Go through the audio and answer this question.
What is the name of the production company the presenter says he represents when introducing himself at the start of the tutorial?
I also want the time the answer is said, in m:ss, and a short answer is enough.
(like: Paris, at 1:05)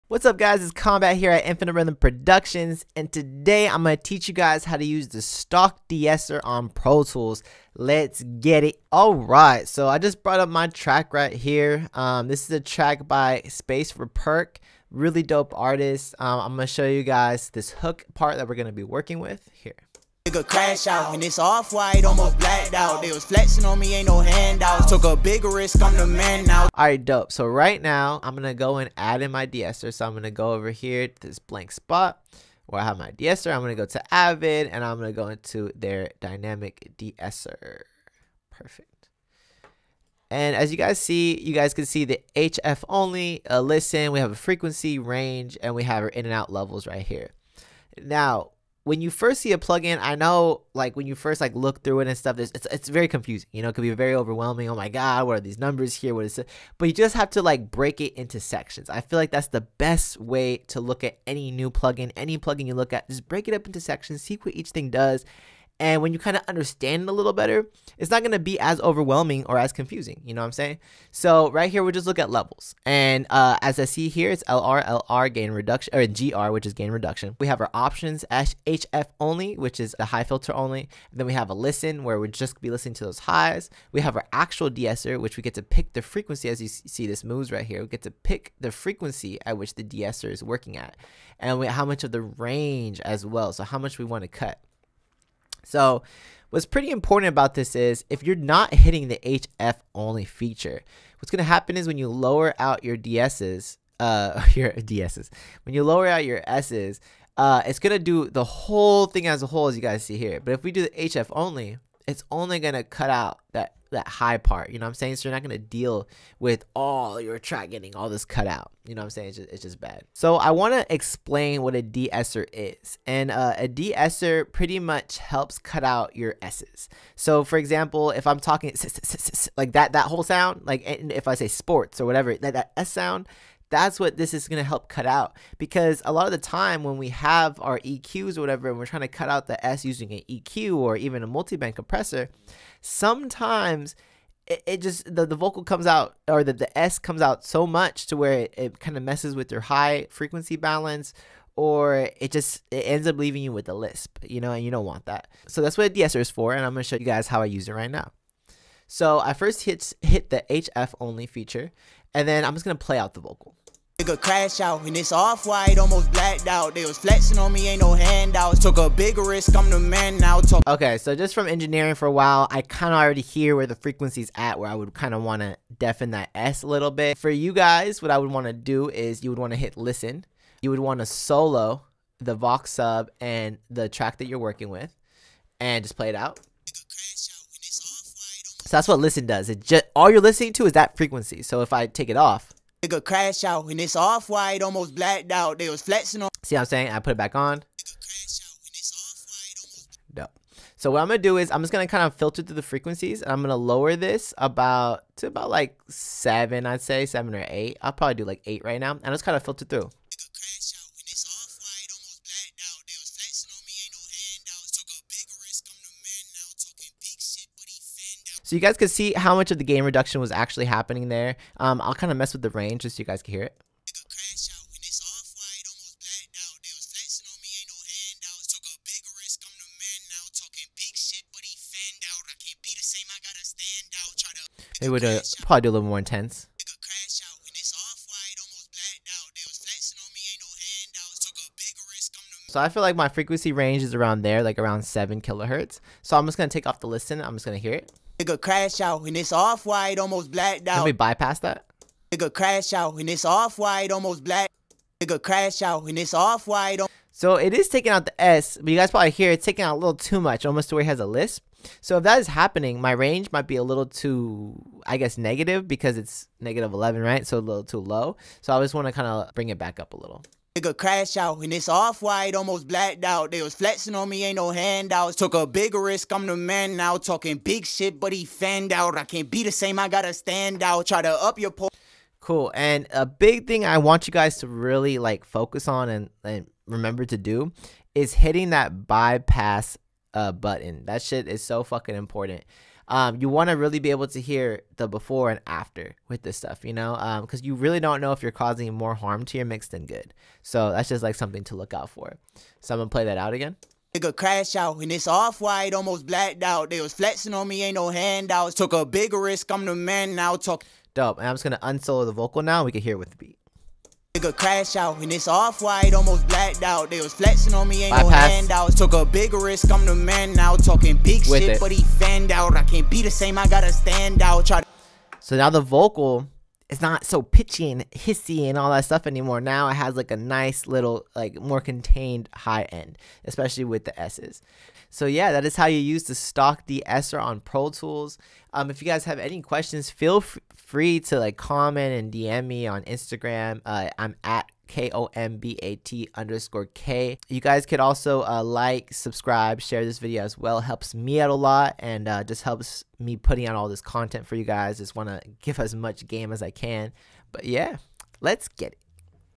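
Infinite Rhythm Productions, at 0:01.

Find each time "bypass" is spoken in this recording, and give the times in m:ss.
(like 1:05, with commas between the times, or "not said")
4:10, 4:48.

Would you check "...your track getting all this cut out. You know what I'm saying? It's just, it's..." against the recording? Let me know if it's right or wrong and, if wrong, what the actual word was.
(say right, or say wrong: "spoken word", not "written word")
right.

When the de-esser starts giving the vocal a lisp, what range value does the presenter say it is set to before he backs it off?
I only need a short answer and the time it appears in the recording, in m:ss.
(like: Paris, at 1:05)
-11, at 4:26.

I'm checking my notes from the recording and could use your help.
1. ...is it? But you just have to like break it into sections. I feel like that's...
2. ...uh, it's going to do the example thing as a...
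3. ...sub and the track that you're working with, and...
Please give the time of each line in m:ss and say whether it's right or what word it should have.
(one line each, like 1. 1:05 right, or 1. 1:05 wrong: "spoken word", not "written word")
1. 0:56 right
2. 1:47 wrong: "whole", not "example"
3. 3:02 right.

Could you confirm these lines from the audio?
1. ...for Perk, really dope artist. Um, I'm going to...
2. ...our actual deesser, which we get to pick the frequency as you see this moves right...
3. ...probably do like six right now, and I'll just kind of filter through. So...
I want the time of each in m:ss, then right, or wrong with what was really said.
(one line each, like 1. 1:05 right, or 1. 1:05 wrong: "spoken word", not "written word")
1. 0:13 right
2. 1:24 right
3. 3:27 wrong: "eight", not "six".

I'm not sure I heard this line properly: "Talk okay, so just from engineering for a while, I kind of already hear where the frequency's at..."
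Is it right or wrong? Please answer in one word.
right.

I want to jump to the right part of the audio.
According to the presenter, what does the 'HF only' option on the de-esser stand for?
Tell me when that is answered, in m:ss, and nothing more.
1:20.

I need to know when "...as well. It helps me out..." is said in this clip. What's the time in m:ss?
5:50.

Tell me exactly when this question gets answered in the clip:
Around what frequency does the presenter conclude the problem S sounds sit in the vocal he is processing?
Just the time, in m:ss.
4:04.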